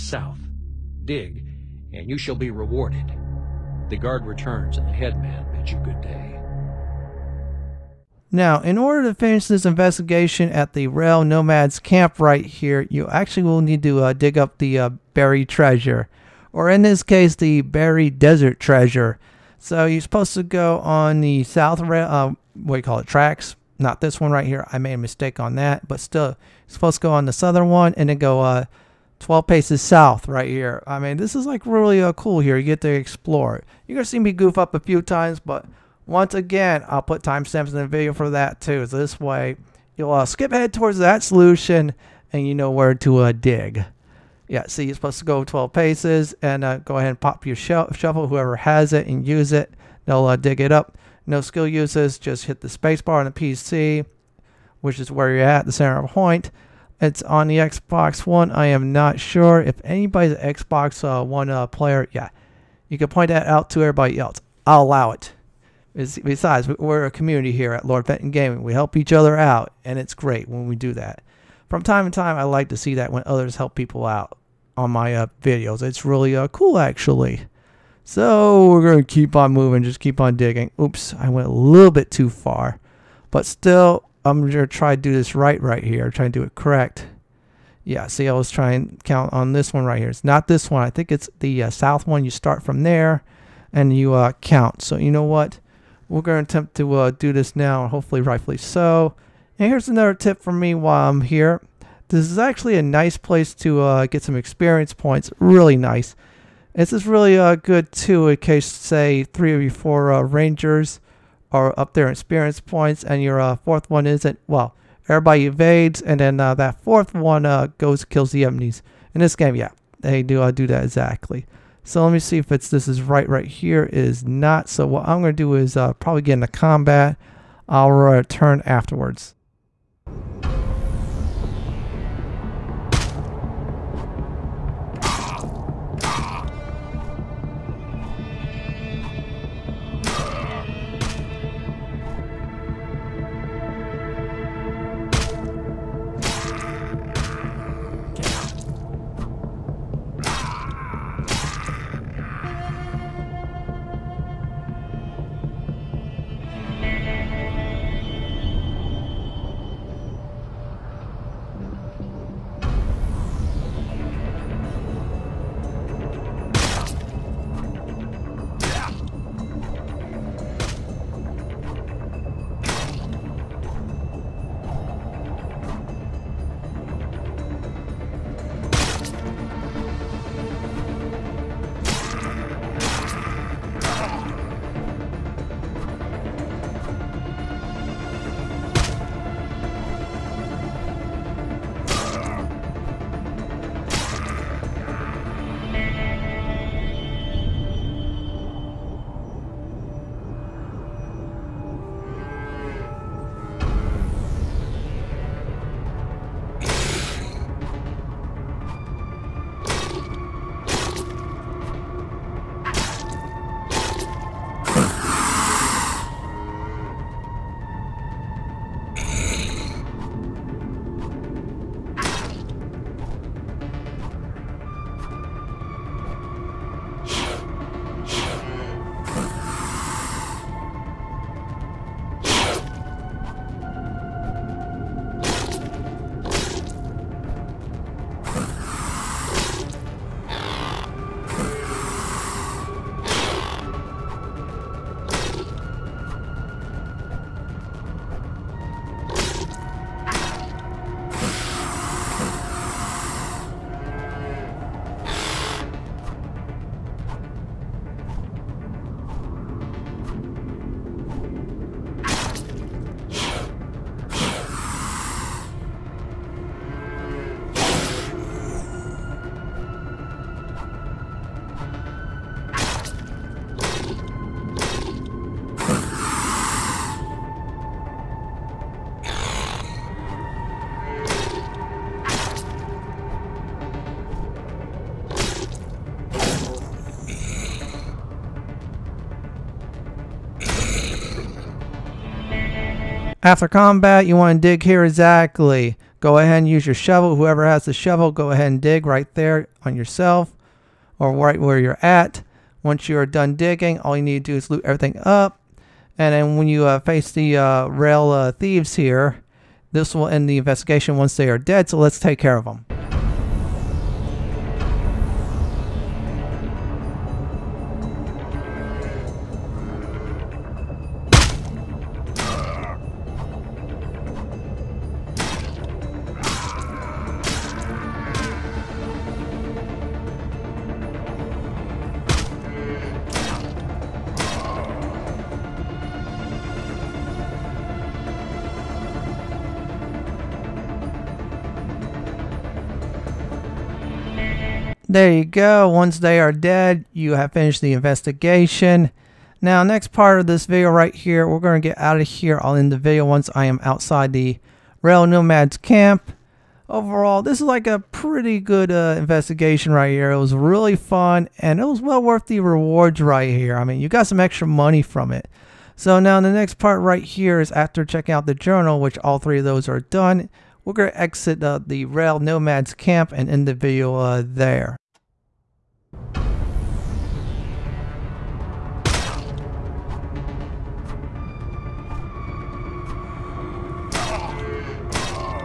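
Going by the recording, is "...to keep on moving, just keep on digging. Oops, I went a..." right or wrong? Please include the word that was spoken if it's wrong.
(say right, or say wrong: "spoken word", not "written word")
right.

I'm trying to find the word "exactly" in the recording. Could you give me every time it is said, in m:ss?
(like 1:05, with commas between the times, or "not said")
2:00, 4:54.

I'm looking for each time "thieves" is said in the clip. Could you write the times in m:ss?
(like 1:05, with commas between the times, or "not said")
5:08.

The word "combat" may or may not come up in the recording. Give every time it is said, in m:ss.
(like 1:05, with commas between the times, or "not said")
2:06, 4:53.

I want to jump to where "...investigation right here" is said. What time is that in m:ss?
5:58.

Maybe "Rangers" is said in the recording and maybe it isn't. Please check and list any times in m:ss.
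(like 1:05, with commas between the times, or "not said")
1:50.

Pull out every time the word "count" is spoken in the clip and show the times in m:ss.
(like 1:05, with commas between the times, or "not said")
1:29, 1:34.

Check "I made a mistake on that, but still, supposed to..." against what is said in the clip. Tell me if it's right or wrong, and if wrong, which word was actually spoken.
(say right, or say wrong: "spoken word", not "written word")
right.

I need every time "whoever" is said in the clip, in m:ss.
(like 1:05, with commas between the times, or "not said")
0:48, 4:57.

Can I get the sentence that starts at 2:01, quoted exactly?
So let me see if it's this is right right here.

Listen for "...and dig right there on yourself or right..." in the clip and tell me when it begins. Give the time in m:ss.
4:58.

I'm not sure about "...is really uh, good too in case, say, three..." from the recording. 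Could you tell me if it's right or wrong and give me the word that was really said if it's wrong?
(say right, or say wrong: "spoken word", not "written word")
right.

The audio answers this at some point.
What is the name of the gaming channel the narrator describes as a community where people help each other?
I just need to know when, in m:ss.
1:07.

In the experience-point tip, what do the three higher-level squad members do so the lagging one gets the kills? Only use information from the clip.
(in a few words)
evades.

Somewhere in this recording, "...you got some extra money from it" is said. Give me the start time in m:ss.
6:03.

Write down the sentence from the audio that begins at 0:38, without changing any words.
So this way, you'll uh, skip ahead towards that solution and you know where to uh, dig.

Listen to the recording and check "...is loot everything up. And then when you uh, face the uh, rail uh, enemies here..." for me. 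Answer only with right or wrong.
wrong.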